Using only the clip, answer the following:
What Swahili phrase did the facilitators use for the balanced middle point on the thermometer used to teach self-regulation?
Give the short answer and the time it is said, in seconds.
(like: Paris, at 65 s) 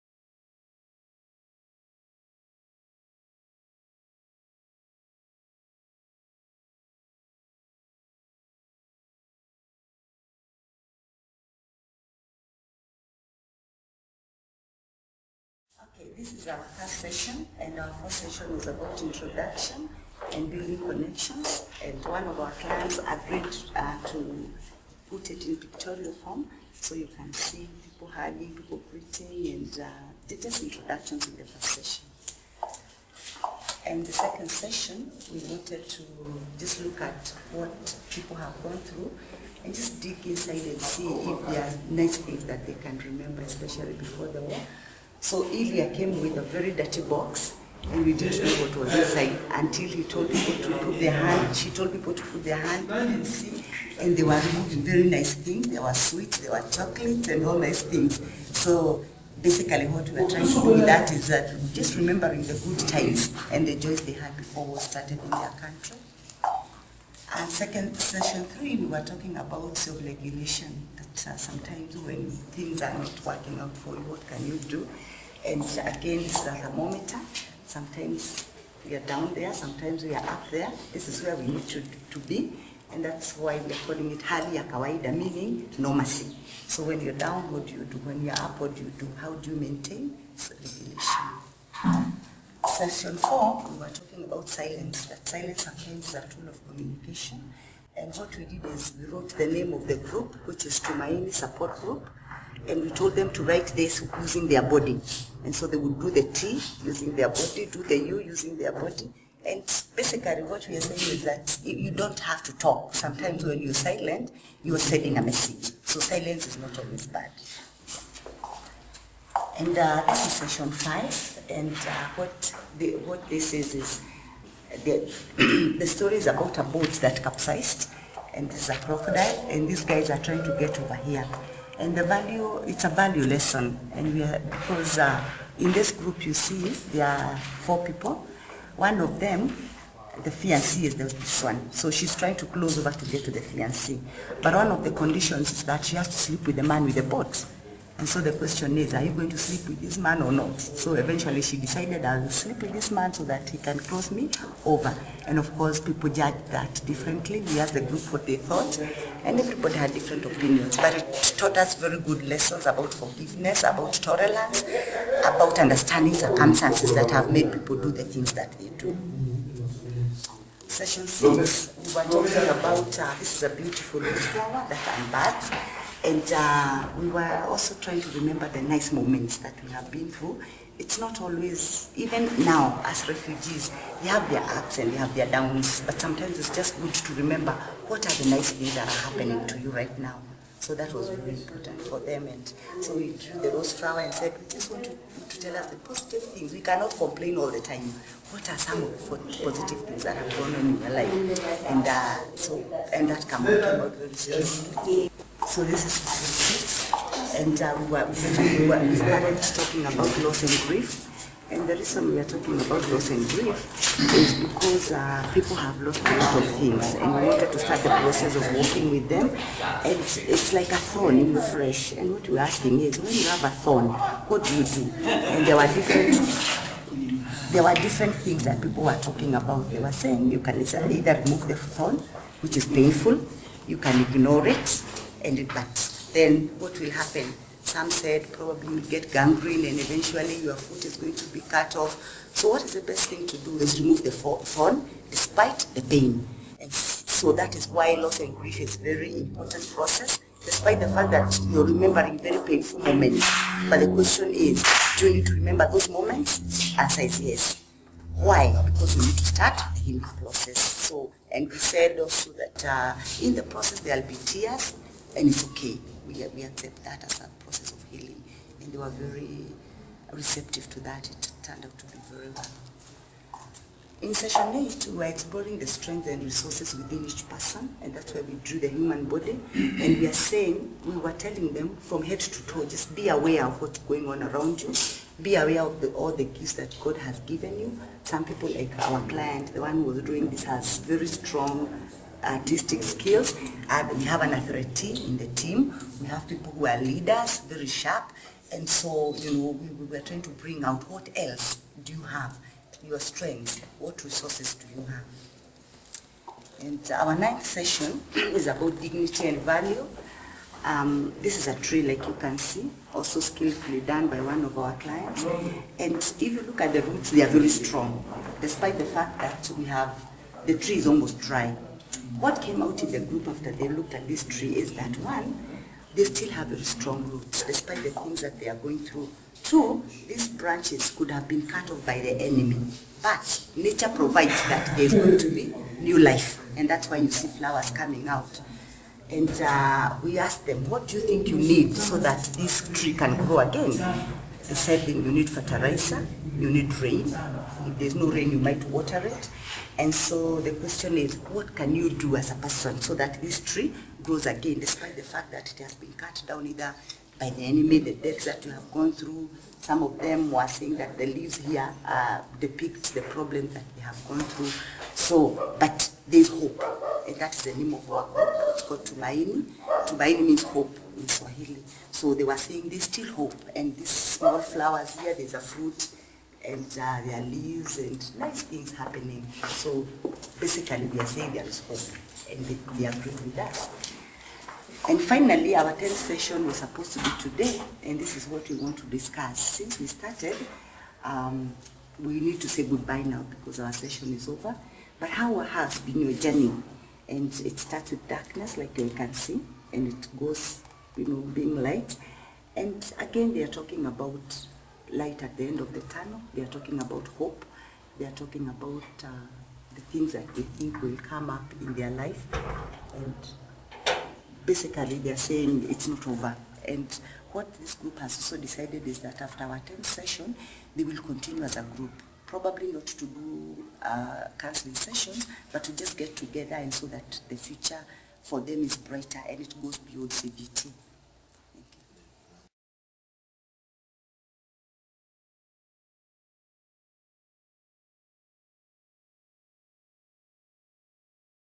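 hali ya kawaida, at 84 s.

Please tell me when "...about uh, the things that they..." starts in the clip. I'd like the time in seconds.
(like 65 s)
408 s.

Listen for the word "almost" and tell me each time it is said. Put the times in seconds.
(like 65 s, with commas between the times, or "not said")
320 s.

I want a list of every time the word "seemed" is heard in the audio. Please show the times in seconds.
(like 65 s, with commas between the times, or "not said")
not said.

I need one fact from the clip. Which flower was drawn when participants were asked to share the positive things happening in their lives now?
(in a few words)
Rose.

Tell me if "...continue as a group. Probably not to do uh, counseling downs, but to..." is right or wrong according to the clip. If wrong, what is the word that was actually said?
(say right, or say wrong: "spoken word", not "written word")
wrong: "sessions", not "downs".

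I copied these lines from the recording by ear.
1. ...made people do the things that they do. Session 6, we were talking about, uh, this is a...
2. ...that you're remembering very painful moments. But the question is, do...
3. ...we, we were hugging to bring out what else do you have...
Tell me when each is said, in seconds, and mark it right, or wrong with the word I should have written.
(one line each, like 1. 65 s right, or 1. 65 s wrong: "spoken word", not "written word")
1. 167 s right
2. 251 s right
3. 299 s wrong: "trying", not "hugging".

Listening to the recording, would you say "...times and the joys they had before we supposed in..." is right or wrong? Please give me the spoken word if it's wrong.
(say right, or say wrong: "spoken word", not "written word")
wrong: "started", not "supposed".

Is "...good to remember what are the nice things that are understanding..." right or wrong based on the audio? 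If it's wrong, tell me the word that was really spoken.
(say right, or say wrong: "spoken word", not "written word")
wrong: "happening", not "understanding".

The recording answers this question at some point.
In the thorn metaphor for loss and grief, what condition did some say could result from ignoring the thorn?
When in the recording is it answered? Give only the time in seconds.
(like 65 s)
239 s.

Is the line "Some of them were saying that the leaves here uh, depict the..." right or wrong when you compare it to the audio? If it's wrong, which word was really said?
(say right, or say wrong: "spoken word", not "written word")
right.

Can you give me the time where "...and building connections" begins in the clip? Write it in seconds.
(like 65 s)
20 s.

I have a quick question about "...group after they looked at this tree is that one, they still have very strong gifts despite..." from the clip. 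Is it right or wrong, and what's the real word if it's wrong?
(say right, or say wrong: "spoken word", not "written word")
wrong: "roots", not "gifts".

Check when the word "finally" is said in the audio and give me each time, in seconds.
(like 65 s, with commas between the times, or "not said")
384 s.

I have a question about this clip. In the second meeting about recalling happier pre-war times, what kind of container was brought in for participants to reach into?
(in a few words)
A very dirty box.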